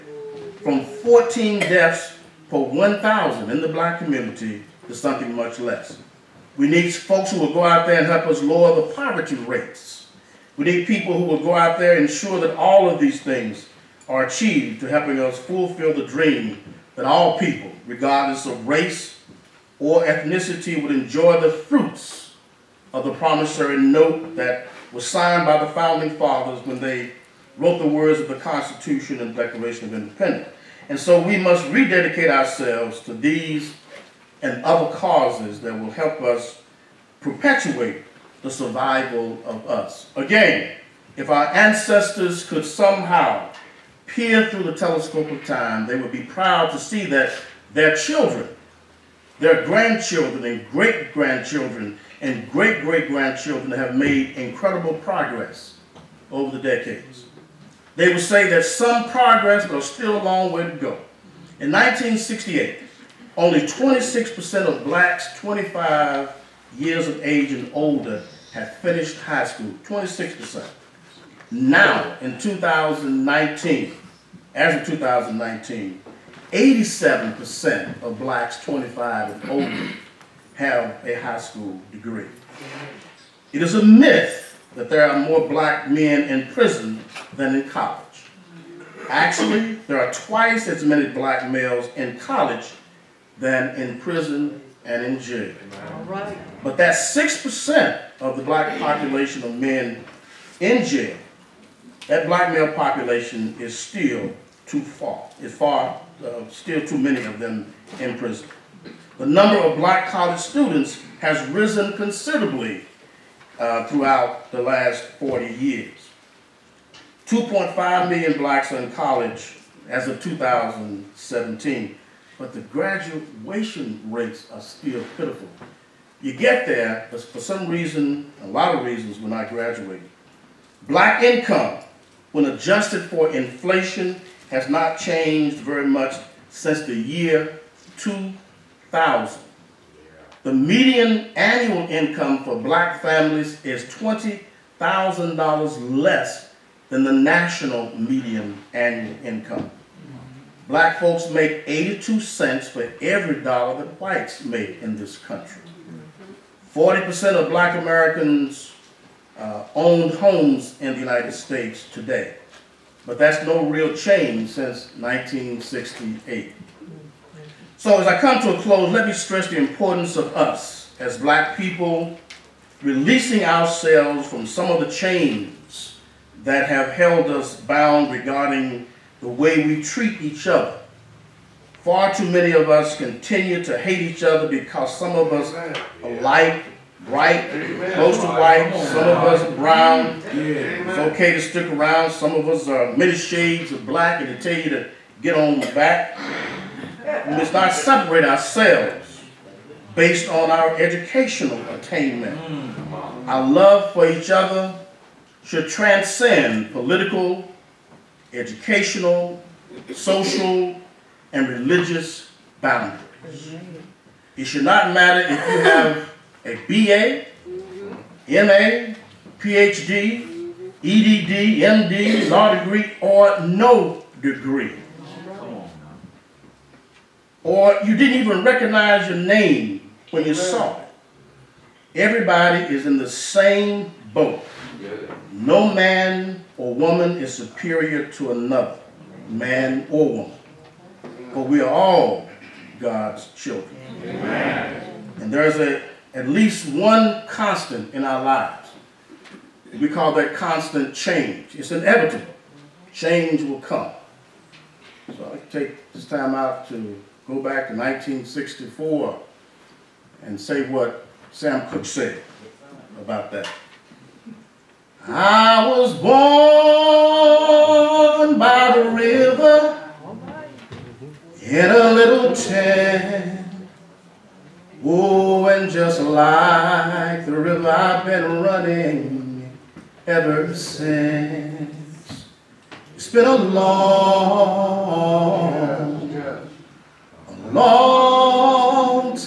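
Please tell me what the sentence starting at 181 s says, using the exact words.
Far too many of us continue to hate each other because some of us alike.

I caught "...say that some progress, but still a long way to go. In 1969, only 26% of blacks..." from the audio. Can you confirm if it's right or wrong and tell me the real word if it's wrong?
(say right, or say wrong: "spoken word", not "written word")
wrong: "1968", not "1969".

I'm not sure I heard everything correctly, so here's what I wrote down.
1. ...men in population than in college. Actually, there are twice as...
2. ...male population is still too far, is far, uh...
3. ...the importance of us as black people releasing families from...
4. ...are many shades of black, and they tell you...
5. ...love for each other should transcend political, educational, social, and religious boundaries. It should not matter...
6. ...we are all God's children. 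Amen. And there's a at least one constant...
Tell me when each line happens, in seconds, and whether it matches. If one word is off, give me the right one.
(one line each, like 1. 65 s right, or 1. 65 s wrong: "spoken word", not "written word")
1. 85 s wrong: "prison", not "population"
2. 102 s right
3. 169 s wrong: "ourselves", not "families"
4. 192 s right
5. 203 s right
6. 241 s right.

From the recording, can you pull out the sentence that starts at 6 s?
We need folks who will go out there and help us lower the poverty rates.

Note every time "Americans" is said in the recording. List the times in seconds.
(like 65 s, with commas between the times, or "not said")
157 s.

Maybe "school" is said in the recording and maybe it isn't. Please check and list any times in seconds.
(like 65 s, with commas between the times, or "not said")
69 s, 81 s.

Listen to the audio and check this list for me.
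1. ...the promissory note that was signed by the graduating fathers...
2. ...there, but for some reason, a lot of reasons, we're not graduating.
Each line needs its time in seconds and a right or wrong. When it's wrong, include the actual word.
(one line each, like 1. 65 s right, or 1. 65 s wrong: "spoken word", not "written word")
1. 23 s wrong: "founding", not "graduating"
2. 126 s right.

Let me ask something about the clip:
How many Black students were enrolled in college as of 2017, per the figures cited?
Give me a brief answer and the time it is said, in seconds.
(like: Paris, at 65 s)
2.5 million, at 117 s.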